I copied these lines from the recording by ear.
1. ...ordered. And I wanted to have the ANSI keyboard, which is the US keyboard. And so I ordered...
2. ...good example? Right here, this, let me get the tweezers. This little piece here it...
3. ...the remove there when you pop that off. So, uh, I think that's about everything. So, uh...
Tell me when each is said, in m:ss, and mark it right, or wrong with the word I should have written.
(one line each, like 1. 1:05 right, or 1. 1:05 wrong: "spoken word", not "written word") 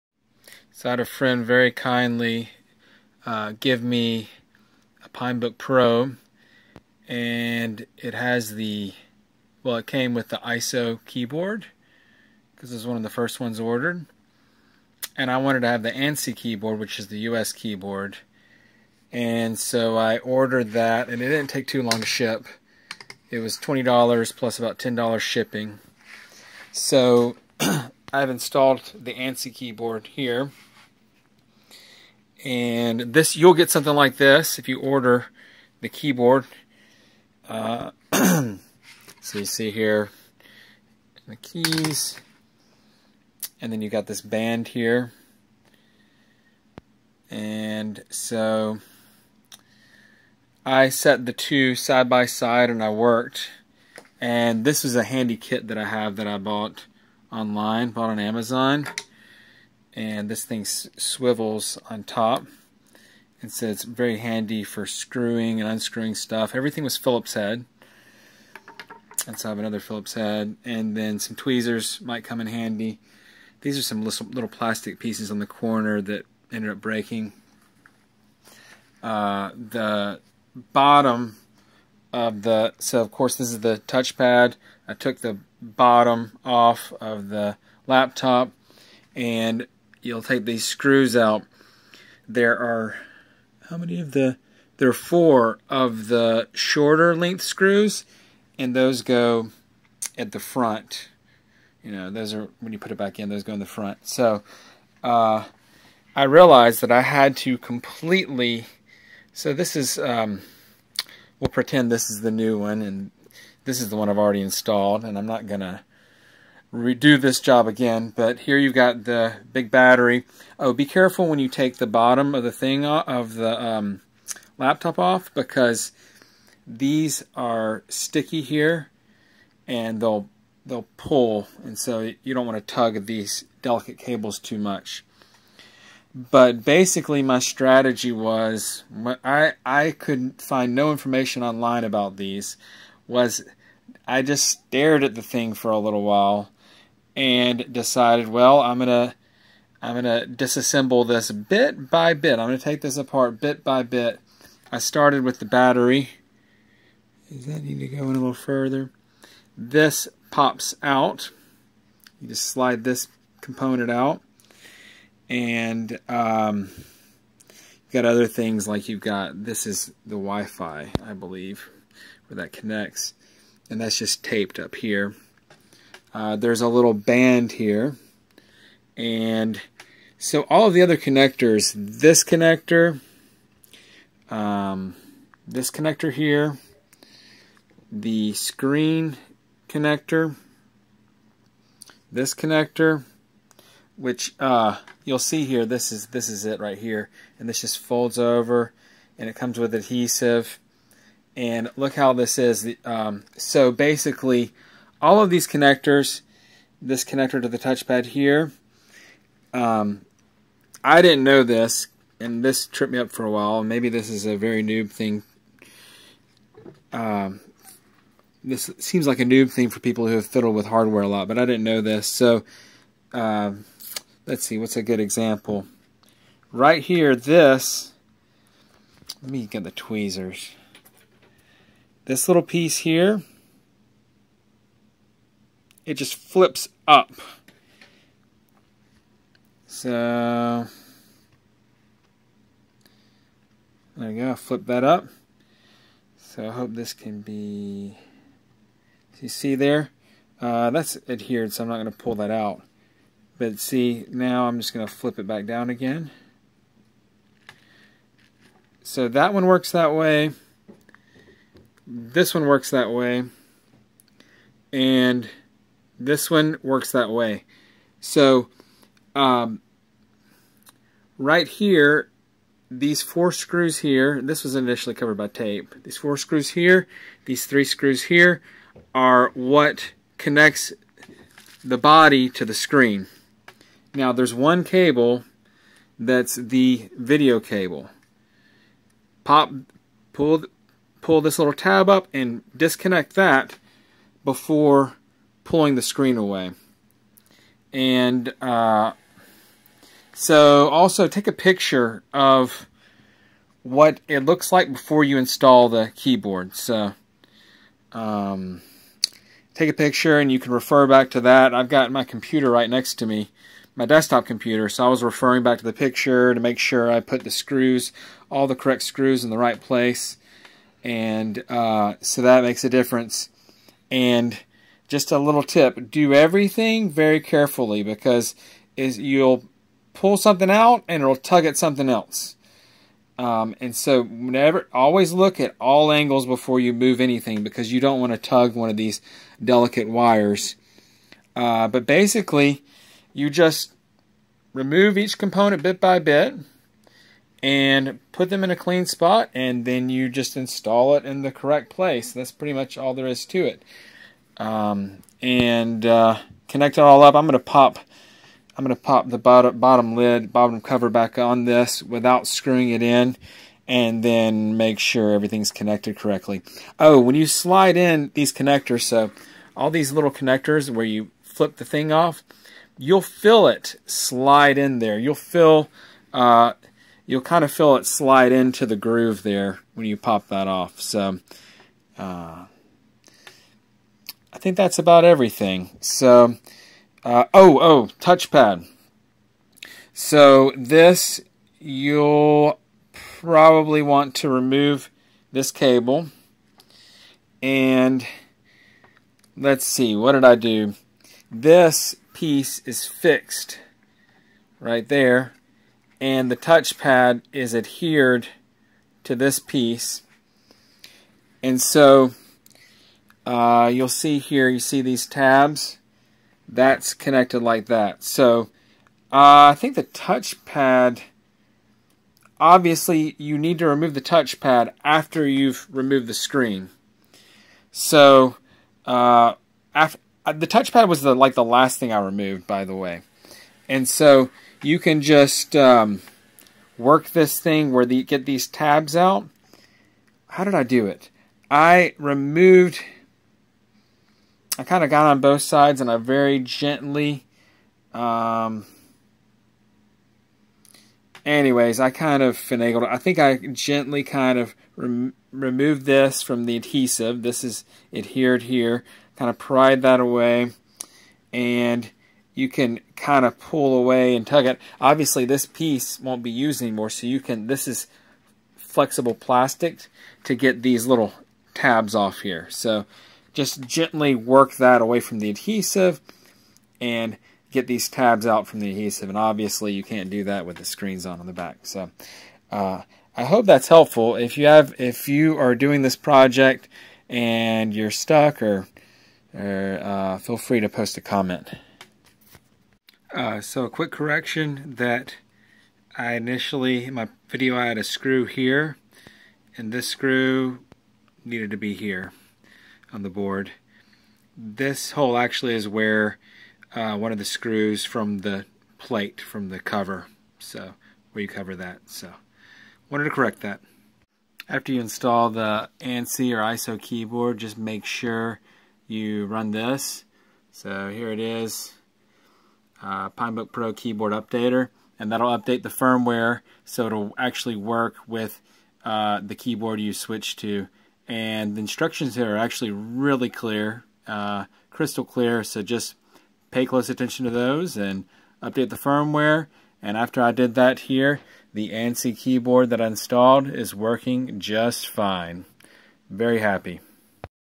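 1. 0:13 right
2. 3:44 right
3. 6:18 wrong: "groove", not "remove".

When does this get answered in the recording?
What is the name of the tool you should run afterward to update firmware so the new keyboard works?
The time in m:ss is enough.
8:43.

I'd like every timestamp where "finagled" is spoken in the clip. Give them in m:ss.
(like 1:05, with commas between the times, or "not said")
7:32.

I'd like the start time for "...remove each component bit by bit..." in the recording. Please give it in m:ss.
5:44.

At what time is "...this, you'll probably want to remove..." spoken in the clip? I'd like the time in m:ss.
6:30.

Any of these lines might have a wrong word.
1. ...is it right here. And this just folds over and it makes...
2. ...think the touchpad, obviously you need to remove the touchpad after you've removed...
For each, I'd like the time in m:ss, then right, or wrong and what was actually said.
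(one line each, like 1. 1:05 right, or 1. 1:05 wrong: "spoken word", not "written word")
1. 3:16 wrong: "comes", not "makes"
2. 6:59 right.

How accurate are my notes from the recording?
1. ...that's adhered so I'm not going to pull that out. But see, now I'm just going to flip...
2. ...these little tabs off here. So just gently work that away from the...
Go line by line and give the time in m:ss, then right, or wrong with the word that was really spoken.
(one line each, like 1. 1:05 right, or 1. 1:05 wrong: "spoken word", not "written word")
1. 4:10 right
2. 7:50 right.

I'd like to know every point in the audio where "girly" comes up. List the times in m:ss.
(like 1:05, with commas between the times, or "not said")
not said.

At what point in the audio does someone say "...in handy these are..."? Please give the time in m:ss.
1:12.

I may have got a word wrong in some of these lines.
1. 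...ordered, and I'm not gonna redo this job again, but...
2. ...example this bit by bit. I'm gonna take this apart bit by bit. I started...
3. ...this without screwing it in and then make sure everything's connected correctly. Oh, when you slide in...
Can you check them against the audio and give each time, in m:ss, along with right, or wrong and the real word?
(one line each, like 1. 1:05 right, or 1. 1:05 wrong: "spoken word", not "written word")
1. 1:54 wrong: "installed", not "ordered"
2. 2:30 wrong: "disassemble", not "example"
3. 6:01 right.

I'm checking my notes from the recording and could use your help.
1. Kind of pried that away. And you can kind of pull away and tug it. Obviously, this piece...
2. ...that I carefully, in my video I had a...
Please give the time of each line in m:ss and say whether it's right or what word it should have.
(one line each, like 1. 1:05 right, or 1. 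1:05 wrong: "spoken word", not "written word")
1. 7:39 right
2. 8:14 wrong: "initially", not "carefully".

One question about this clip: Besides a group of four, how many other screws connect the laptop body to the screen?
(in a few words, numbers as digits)
3.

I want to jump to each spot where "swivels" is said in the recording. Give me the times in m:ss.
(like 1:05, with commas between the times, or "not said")
1:00.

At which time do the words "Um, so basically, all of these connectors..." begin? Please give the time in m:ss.
3:22.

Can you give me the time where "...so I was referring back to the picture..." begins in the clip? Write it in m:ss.
5:14.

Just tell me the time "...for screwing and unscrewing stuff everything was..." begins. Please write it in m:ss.
1:04.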